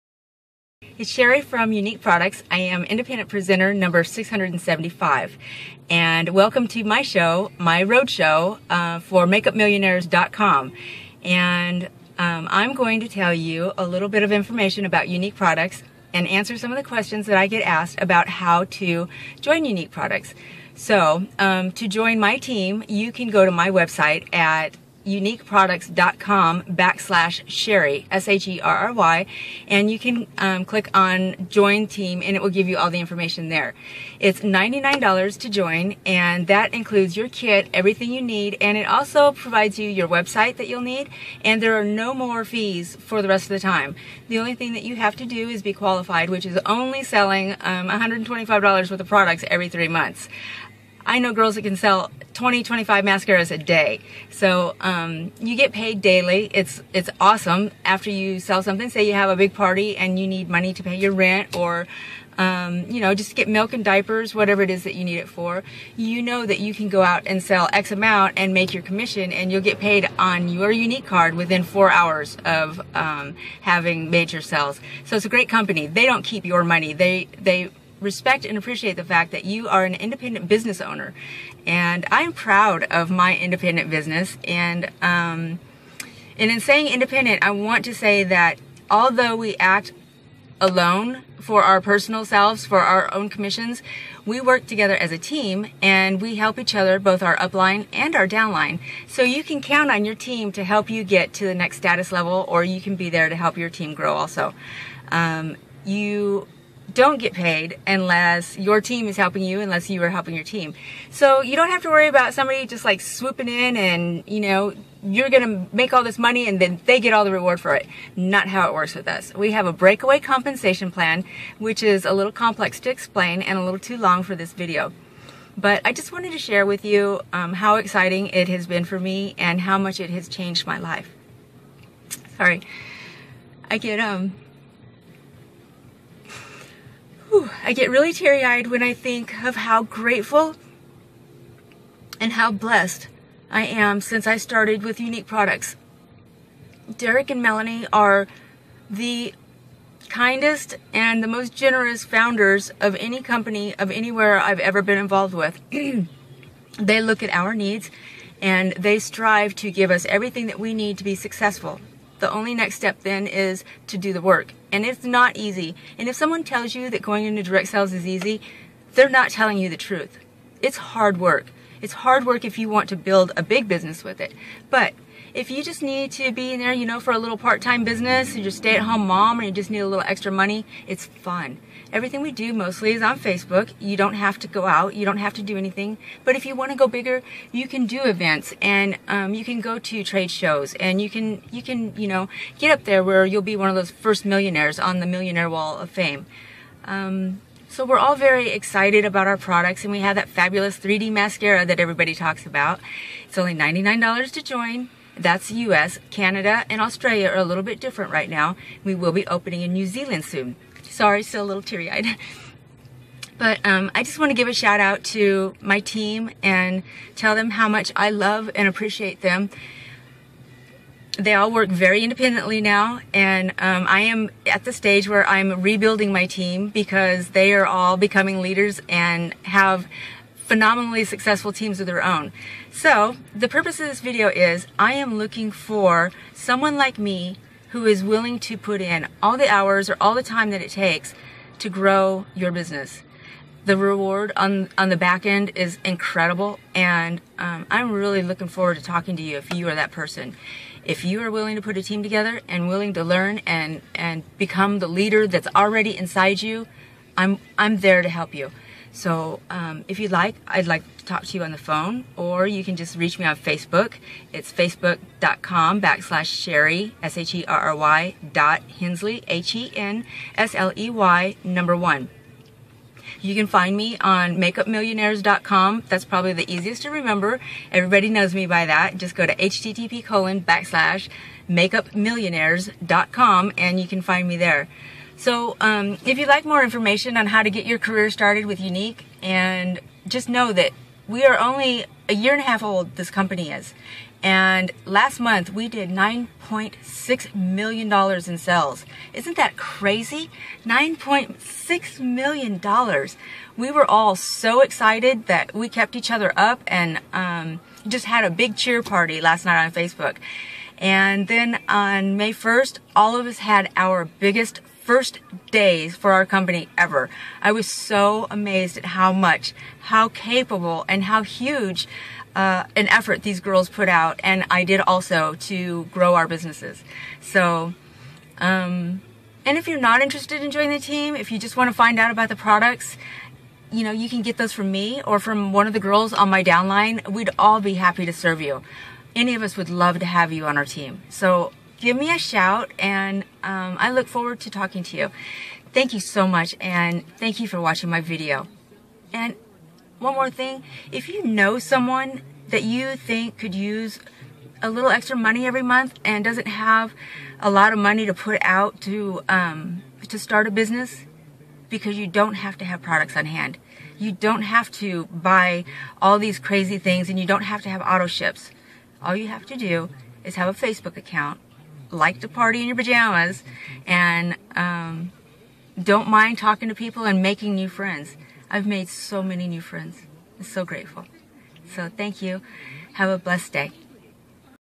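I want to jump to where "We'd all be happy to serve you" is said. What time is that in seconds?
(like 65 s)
337 s.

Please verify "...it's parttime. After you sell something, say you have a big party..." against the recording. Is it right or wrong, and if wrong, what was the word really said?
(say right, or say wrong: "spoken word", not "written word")
wrong: "awesome", not "parttime".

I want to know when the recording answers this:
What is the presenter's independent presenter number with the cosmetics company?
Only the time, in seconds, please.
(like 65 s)
4 s.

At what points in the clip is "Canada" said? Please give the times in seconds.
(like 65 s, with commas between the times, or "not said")
206 s.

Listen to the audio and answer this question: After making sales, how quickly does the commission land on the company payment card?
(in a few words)
within 4 hours.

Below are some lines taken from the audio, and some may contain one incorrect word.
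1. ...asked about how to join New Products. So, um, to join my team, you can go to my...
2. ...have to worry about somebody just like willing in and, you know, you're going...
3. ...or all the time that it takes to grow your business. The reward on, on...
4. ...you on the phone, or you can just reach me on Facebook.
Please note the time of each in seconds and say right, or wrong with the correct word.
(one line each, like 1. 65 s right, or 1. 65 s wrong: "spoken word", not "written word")
1. 17 s wrong: "Younique", not "New"
2. 111 s wrong: "swooping", not "willing"
3. 239 s right
4. 261 s right.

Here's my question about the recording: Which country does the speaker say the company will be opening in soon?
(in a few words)
New Zealand.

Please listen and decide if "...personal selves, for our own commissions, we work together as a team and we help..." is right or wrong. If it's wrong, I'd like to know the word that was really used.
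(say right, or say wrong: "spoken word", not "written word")
right.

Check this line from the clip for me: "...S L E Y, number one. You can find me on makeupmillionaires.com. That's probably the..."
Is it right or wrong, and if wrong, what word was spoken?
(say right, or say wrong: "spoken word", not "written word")
right.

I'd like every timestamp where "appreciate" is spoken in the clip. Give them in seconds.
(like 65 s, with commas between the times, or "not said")
78 s, 218 s.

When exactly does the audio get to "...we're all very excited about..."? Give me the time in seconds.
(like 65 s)
197 s.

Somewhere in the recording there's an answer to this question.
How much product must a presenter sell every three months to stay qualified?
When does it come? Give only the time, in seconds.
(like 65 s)
47 s.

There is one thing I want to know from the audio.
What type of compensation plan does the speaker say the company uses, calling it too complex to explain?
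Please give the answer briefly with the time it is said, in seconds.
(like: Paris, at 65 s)
breakaway compensation plan, at 119 s.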